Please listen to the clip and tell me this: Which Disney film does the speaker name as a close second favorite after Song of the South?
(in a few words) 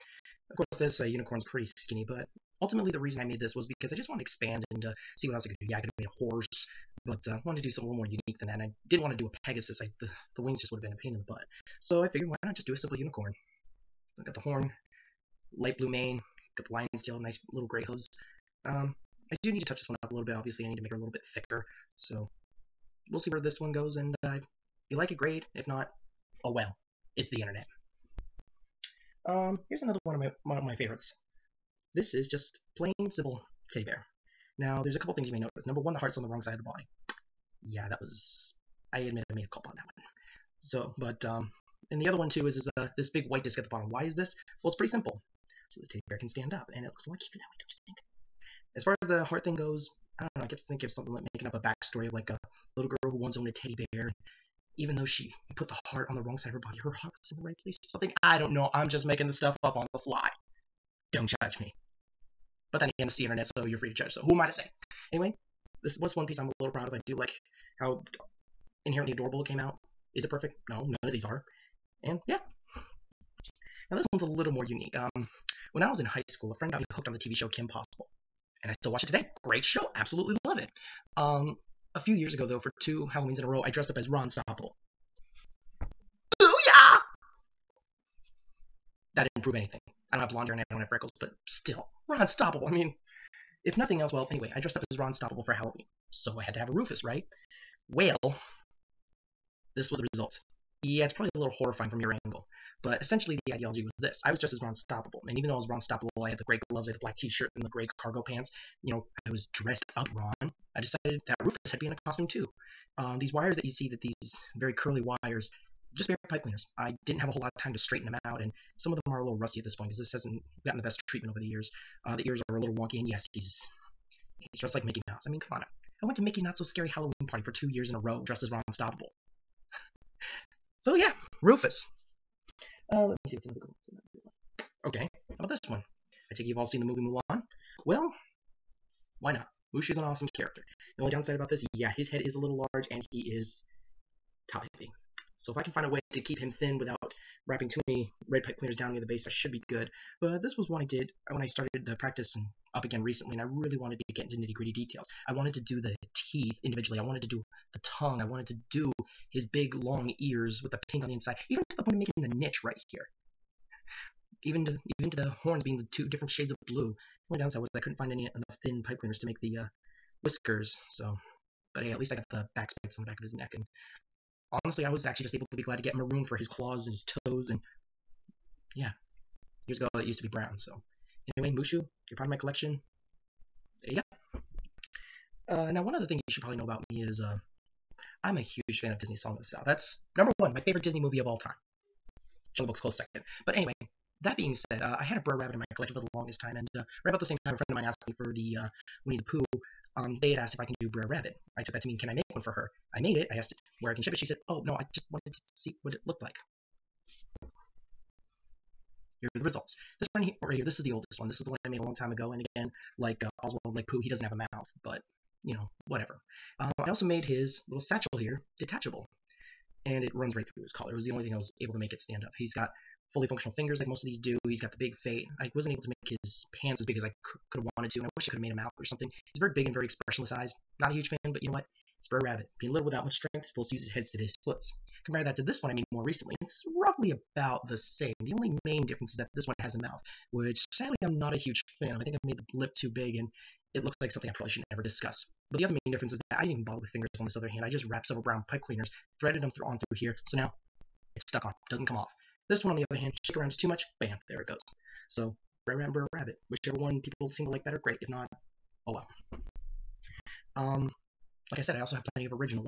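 Jungle Book.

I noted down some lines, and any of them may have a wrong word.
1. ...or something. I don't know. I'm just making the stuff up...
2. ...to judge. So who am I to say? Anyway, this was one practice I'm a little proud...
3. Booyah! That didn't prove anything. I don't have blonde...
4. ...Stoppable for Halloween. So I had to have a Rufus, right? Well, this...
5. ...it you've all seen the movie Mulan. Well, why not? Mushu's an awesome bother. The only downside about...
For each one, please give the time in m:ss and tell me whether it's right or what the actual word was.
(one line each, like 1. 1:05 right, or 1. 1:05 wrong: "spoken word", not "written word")
1. 0:57 right
2. 1:03 wrong: "piece", not "practice"
3. 1:26 right
4. 1:35 right
5. 2:16 wrong: "character", not "bother".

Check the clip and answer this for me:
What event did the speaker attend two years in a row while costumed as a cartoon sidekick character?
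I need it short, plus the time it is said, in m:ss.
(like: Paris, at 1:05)
Mickey's Not So Scary Halloween Party, at 2:06.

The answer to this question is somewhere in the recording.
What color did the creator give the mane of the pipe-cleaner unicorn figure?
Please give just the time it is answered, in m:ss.
0:15.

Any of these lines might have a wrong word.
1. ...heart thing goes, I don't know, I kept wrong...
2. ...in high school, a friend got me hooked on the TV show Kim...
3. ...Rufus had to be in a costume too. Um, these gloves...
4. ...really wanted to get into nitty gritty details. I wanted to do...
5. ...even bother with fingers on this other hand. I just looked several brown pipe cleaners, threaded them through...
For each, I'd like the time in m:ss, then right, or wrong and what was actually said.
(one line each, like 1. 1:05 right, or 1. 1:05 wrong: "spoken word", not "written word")
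1. 0:49 wrong: "thinking", not "wrong"
2. 1:15 right
3. 1:51 wrong: "wires", not "gloves"
4. 2:33 right
5. 4:06 wrong: "wrapped", not "looked".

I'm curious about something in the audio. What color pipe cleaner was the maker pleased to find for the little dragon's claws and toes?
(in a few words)
Maroon.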